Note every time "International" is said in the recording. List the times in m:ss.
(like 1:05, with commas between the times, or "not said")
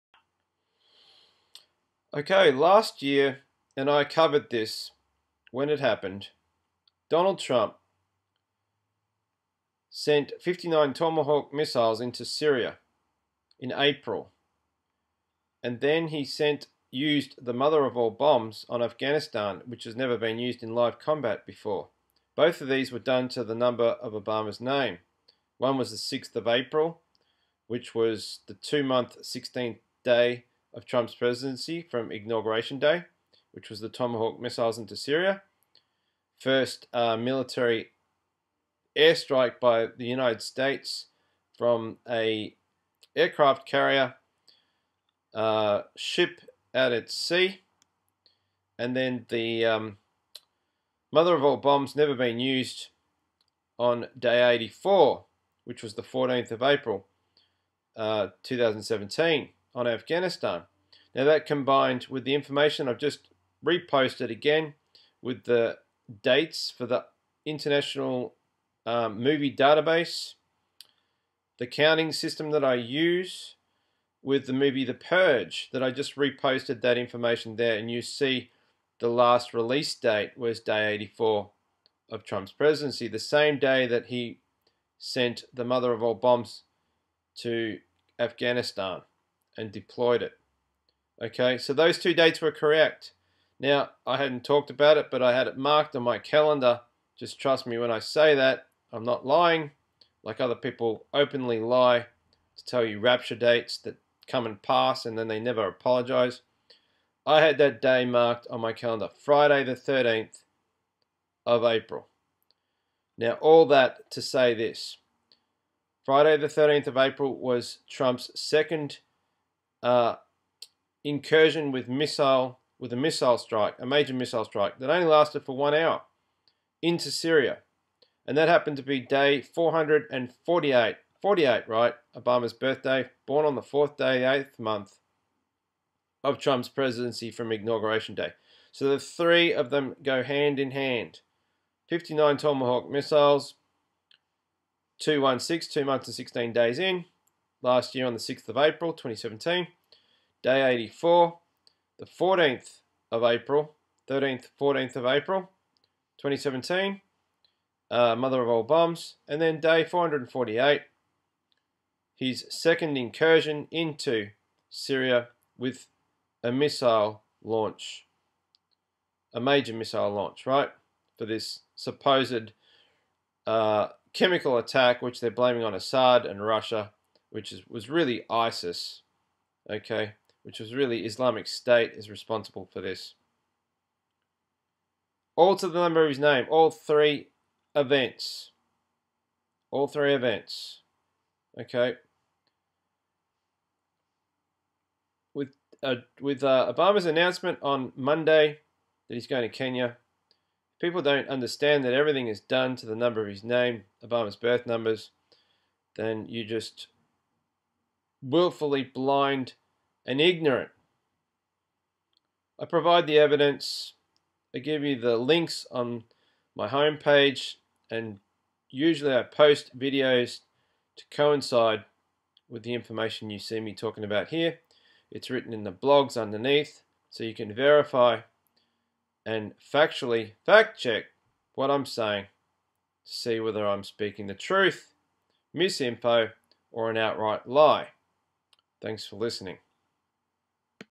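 1:07.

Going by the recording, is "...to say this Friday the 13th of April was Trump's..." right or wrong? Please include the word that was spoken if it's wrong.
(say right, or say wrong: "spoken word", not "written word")
right.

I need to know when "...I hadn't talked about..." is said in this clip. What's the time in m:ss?
1:34.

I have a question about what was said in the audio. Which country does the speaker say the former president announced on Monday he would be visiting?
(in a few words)
Kenya.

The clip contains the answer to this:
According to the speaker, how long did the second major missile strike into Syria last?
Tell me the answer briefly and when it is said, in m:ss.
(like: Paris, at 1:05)
one hour, at 2:05.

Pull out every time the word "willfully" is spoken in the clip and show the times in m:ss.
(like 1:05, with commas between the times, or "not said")
3:28.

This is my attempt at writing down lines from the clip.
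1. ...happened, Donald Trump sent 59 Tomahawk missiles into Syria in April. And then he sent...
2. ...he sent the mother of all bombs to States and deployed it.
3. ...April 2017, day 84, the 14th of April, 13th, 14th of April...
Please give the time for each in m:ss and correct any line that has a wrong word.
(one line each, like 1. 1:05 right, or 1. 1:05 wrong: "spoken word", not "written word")
1. 0:05 right
2. 1:24 wrong: "Afghanistan", not "States"
3. 2:28 right.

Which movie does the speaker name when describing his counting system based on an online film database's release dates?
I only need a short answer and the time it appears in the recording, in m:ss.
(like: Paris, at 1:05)
The Purge, at 1:14.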